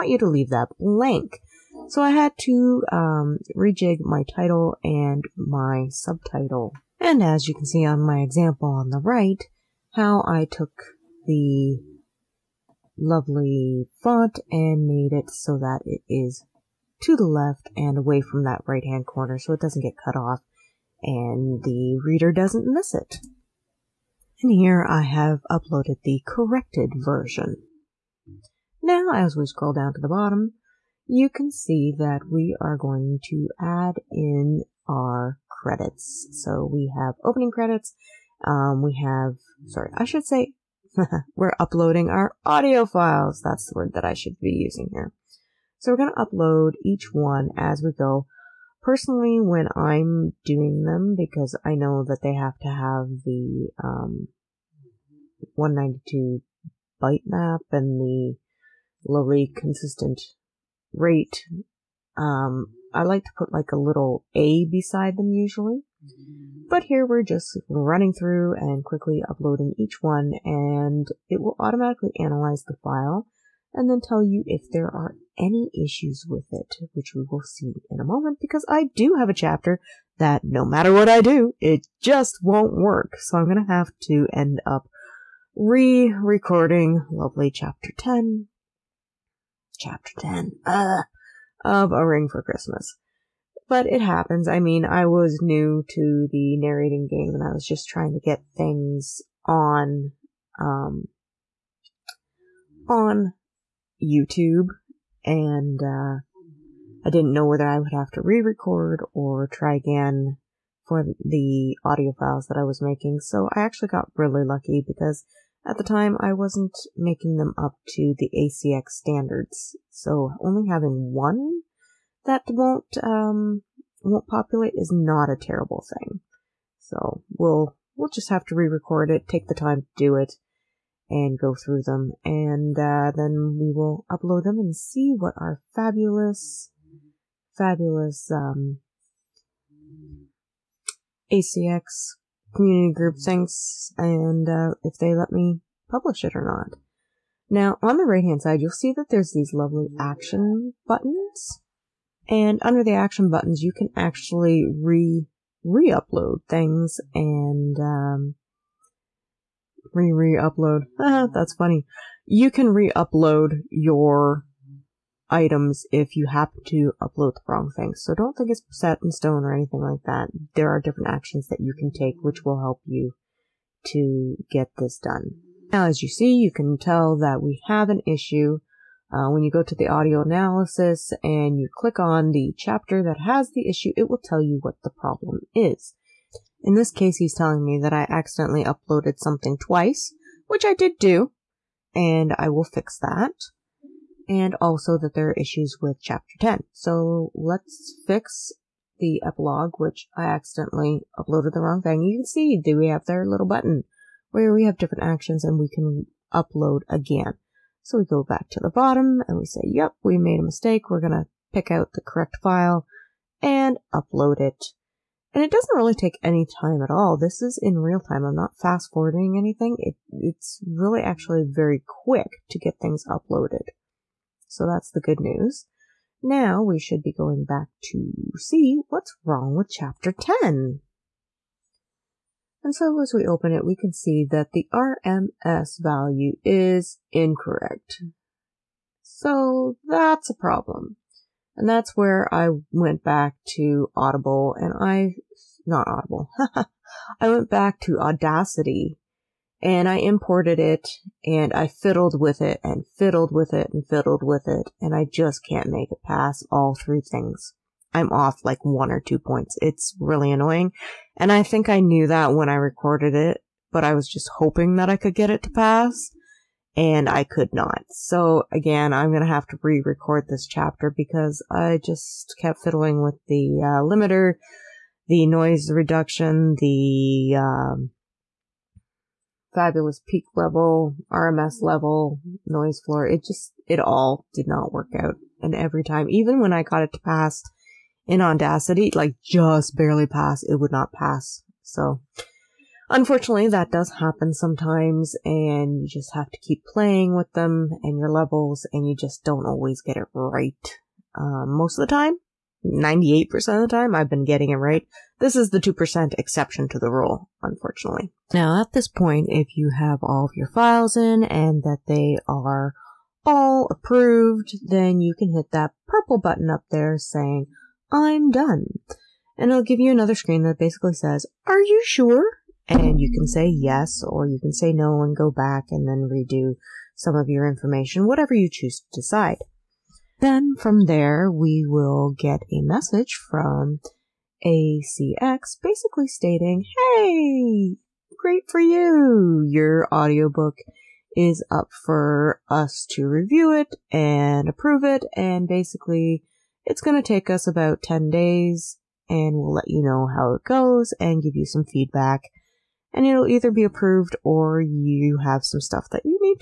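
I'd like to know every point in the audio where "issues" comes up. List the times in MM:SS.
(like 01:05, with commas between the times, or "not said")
01:15, 02:58, 03:03, 03:15.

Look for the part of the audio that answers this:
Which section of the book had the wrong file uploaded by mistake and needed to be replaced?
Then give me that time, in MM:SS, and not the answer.
03:18.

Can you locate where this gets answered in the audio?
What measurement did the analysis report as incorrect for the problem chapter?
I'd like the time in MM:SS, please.
03:54.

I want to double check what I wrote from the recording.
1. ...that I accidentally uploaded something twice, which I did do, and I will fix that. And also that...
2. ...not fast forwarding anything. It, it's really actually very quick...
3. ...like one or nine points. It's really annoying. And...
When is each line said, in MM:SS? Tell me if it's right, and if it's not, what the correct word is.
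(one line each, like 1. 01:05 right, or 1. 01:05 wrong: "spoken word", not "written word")
1. 03:07 right
2. 03:38 right
3. 04:18 wrong: "two", not "nine".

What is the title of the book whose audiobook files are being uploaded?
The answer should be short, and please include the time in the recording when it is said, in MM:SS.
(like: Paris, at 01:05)
A Ring for Christmas, at 01:31.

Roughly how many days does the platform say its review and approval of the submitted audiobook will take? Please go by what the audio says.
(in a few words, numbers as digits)
10 days.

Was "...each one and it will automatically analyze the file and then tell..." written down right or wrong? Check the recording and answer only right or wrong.
right.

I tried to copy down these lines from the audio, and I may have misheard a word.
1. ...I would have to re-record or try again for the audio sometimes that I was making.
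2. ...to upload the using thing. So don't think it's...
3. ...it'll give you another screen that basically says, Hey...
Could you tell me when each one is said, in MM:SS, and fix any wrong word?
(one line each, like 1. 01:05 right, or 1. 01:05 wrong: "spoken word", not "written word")
1. 01:47 wrong: "files", not "sometimes"
2. 02:46 wrong: "wrong", not "using"
3. 05:19 wrong: "Are", not "Hey".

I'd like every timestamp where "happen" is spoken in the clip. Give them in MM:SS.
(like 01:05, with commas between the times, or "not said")
01:34, 02:46, 04:53.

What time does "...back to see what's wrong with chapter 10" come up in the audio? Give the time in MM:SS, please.
03:47.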